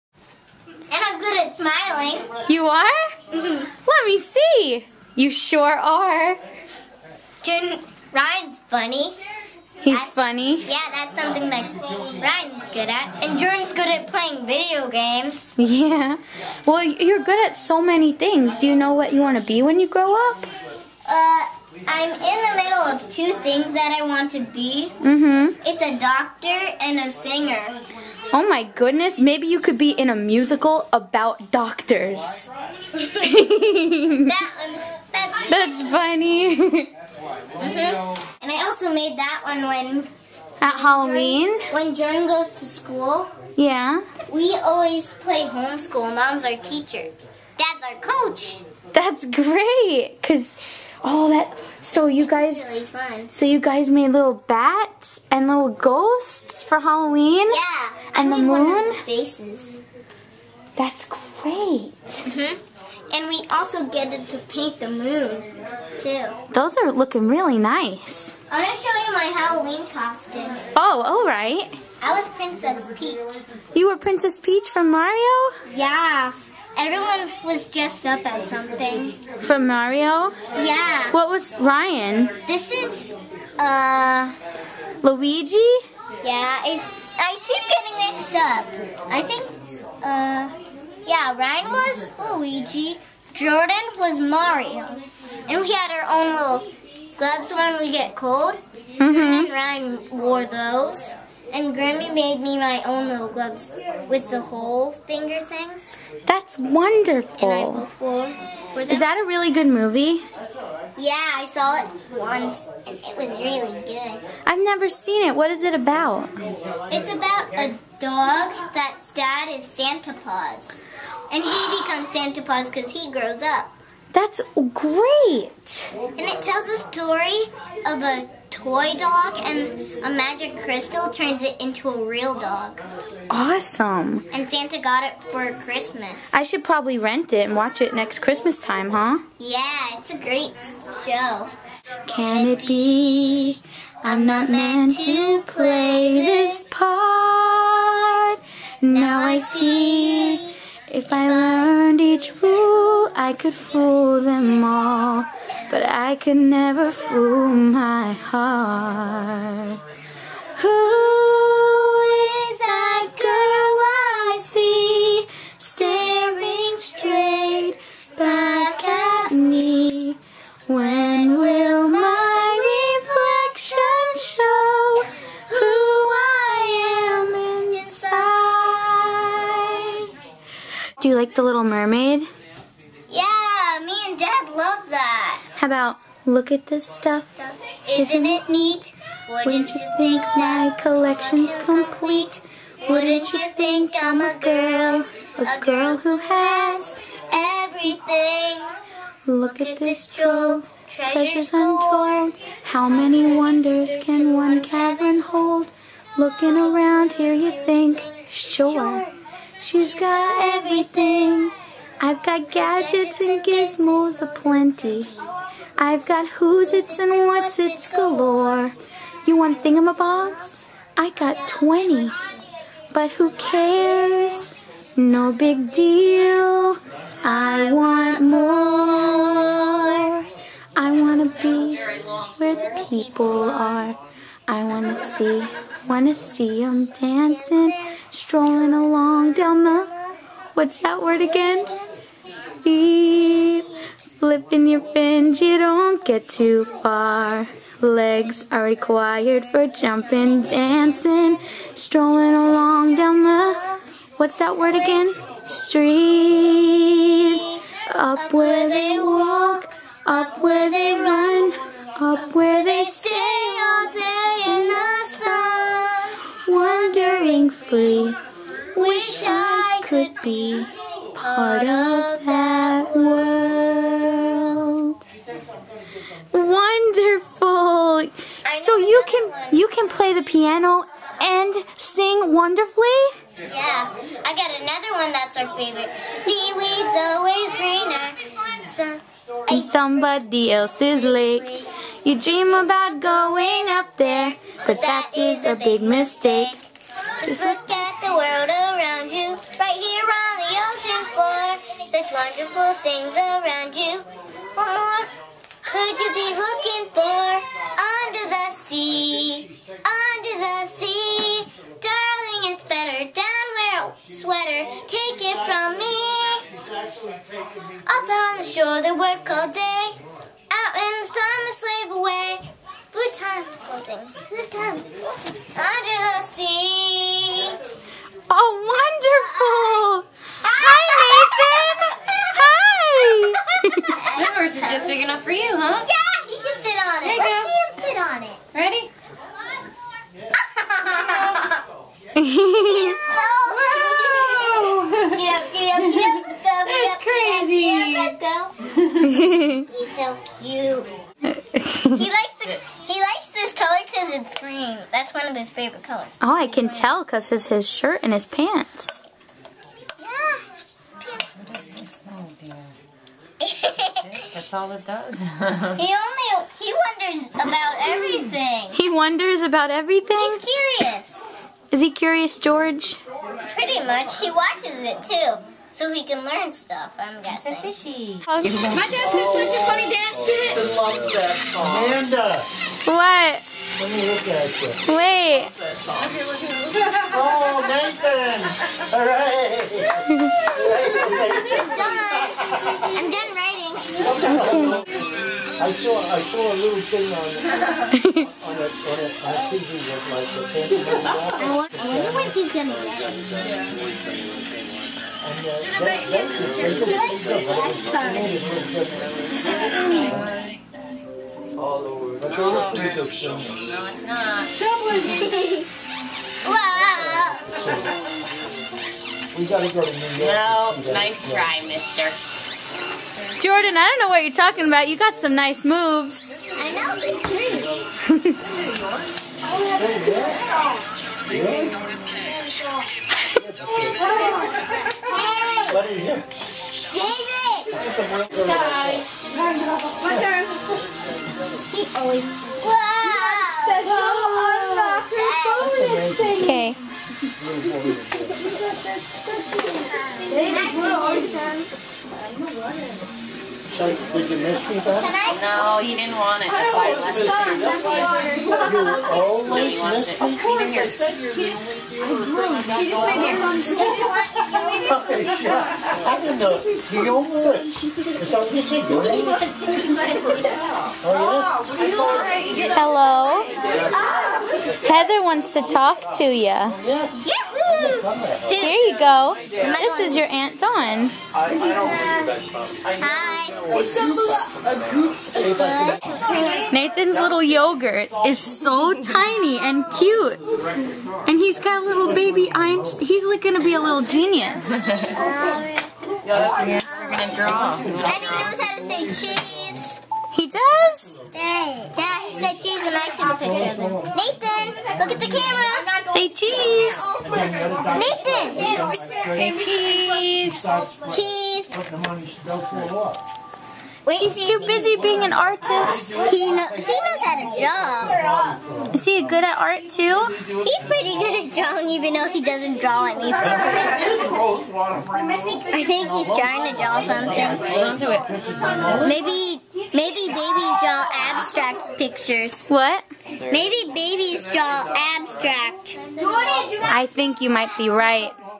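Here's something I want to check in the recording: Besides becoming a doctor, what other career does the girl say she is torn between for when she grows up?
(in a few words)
Singer.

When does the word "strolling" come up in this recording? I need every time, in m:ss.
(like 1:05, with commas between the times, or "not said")
3:58, 4:11.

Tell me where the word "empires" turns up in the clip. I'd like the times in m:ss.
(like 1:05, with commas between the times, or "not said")
not said.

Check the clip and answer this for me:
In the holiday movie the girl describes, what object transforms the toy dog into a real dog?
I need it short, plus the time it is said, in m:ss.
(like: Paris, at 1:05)
A magic crystal, at 2:10.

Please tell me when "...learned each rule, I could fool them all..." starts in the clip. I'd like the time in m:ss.
2:31.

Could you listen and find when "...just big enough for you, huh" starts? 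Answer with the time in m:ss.
5:34.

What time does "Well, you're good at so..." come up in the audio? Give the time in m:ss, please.
0:16.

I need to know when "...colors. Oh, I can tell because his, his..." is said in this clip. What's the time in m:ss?
5:55.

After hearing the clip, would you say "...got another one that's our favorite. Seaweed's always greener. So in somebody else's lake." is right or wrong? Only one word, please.
right.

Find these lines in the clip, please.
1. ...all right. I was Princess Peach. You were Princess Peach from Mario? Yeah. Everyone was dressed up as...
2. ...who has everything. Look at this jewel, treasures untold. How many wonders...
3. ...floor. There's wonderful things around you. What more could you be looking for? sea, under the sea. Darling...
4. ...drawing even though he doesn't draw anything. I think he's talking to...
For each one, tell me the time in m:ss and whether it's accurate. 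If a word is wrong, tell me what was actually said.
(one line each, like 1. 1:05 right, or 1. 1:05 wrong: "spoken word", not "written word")
1. 1:11 right
2. 3:15 right
3. 5:01 right
4. 8:41 wrong: "trying", not "talking".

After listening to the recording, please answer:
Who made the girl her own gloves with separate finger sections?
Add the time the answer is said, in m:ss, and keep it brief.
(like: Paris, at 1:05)
Grammy, at 1:41.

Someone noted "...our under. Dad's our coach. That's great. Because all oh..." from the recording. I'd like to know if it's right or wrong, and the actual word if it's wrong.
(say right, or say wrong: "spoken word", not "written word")
wrong: "teacher", not "under".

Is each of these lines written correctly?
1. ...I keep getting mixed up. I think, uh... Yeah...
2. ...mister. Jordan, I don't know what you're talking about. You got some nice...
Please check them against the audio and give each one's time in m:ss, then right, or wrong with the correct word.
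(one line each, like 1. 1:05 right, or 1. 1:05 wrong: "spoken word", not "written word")
1. 1:27 right
2. 7:01 right.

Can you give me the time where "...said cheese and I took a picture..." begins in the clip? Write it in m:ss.
8:22.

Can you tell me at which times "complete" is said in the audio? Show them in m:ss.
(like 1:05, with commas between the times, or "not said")
3:11.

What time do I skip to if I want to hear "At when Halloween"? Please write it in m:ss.
0:40.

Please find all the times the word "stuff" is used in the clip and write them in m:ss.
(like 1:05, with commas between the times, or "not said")
3:06, 6:16.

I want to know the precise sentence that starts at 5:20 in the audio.
Out in the sun, they slave away.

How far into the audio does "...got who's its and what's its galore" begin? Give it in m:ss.
3:36.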